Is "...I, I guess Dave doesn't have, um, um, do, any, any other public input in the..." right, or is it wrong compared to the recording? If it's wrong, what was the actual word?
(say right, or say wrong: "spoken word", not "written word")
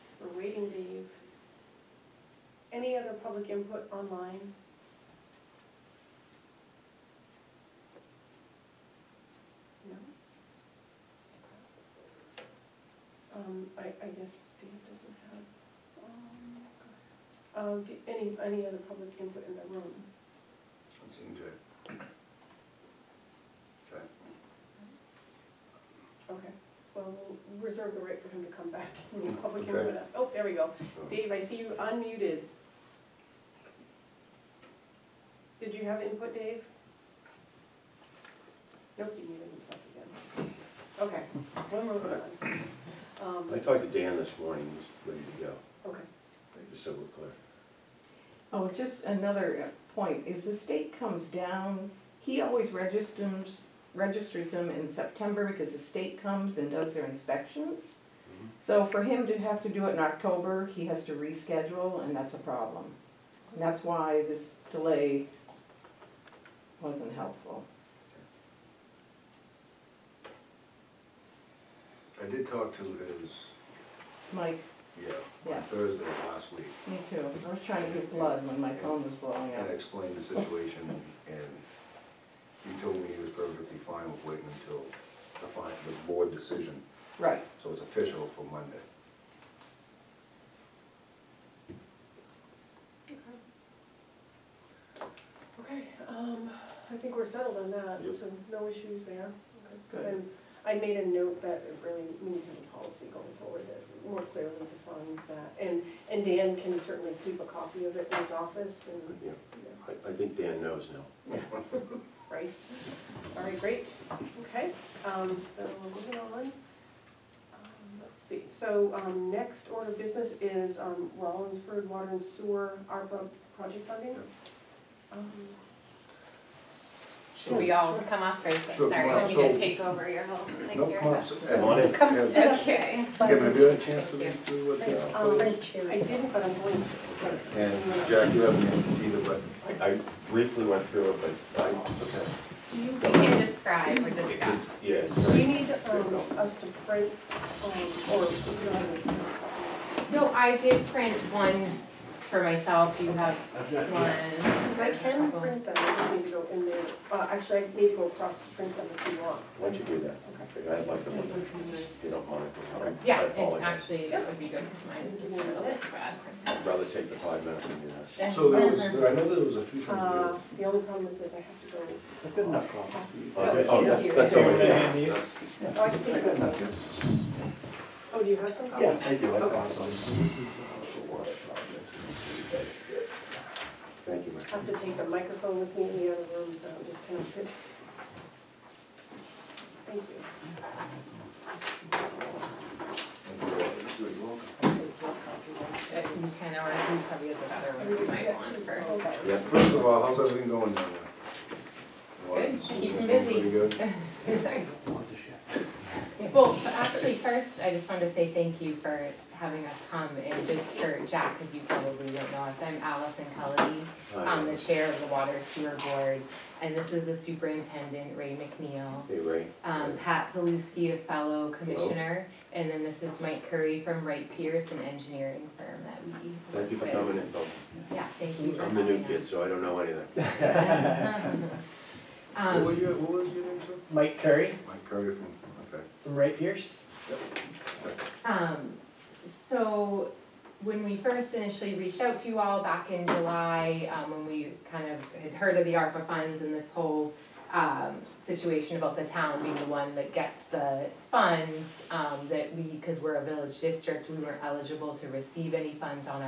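right.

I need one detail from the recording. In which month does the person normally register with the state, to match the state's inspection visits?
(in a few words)
September.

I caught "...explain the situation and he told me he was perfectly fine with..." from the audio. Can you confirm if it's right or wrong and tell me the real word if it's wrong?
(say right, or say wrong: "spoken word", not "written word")
right.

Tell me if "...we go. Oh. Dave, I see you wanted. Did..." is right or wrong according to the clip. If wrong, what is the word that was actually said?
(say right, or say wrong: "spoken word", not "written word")
wrong: "unmuted", not "wanted".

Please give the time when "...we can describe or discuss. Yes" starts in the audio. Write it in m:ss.
2:22.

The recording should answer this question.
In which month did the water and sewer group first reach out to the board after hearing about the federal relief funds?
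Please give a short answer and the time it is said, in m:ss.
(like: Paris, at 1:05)
July, at 4:03.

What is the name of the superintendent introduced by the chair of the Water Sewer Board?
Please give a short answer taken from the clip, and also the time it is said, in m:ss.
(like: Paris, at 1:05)
Ray McNeil, at 3:38.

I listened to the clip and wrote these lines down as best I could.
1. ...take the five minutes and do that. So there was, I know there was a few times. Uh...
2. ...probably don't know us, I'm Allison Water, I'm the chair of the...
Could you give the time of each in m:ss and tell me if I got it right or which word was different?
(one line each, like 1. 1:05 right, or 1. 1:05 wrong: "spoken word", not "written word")
1. 2:46 right
2. 3:31 wrong: "Kelly", not "Water".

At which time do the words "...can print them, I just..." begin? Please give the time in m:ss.
2:34.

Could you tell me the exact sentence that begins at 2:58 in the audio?
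Yeah, I do, I got some.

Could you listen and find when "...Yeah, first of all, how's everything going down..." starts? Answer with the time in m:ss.
3:19.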